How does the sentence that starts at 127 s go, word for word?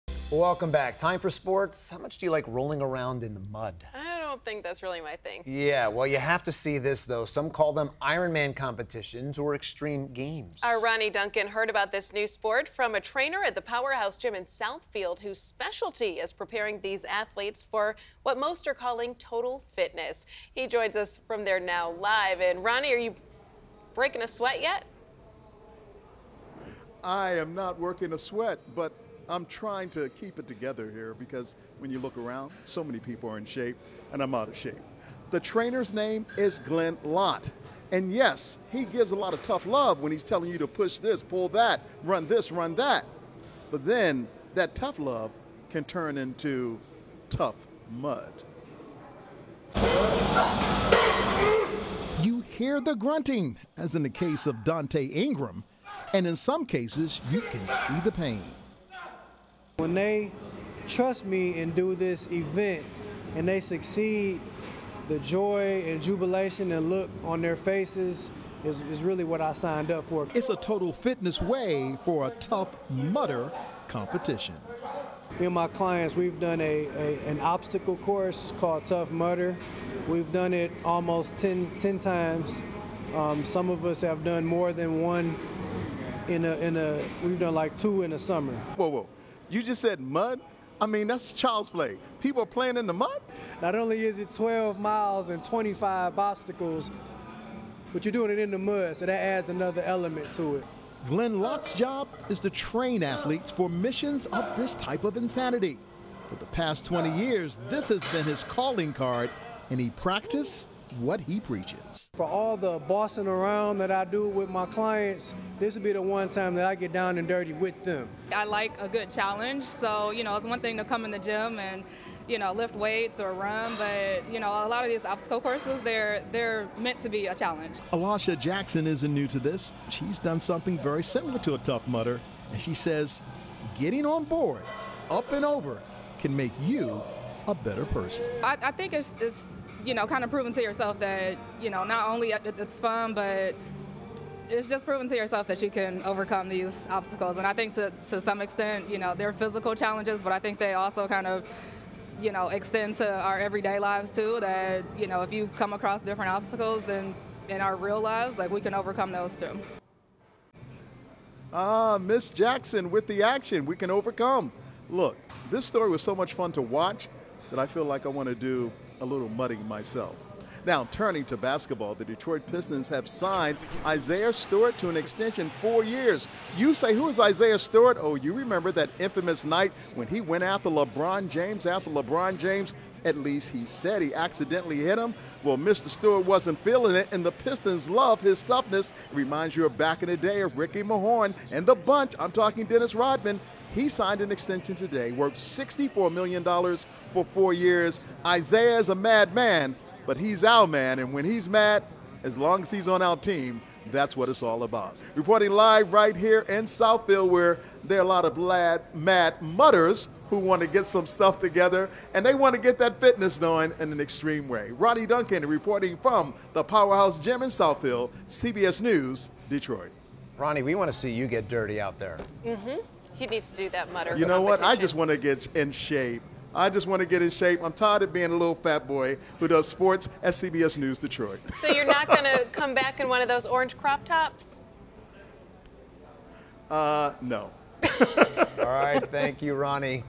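Alasha Jackson isn't new to this.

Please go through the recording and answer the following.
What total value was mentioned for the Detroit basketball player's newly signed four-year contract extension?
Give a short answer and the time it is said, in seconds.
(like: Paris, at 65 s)
$64 million, at 195 s.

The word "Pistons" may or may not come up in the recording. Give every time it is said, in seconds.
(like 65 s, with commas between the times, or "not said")
172 s, 187 s.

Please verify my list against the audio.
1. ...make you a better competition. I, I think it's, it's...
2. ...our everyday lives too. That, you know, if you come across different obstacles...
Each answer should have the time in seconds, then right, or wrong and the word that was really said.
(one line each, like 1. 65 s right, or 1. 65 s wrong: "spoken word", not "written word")
1. 136 s wrong: "person", not "competition"
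2. 153 s right.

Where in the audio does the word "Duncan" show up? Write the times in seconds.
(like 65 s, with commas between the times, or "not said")
11 s, 215 s.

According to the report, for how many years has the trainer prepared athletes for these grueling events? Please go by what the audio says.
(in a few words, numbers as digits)
20.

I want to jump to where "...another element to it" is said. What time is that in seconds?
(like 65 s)
99 s.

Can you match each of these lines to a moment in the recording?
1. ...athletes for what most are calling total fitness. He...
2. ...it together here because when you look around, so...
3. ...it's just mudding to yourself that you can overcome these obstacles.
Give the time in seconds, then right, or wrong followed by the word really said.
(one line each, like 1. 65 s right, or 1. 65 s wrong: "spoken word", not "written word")
1. 17 s right
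2. 30 s right
3. 144 s wrong: "proving", not "mudding".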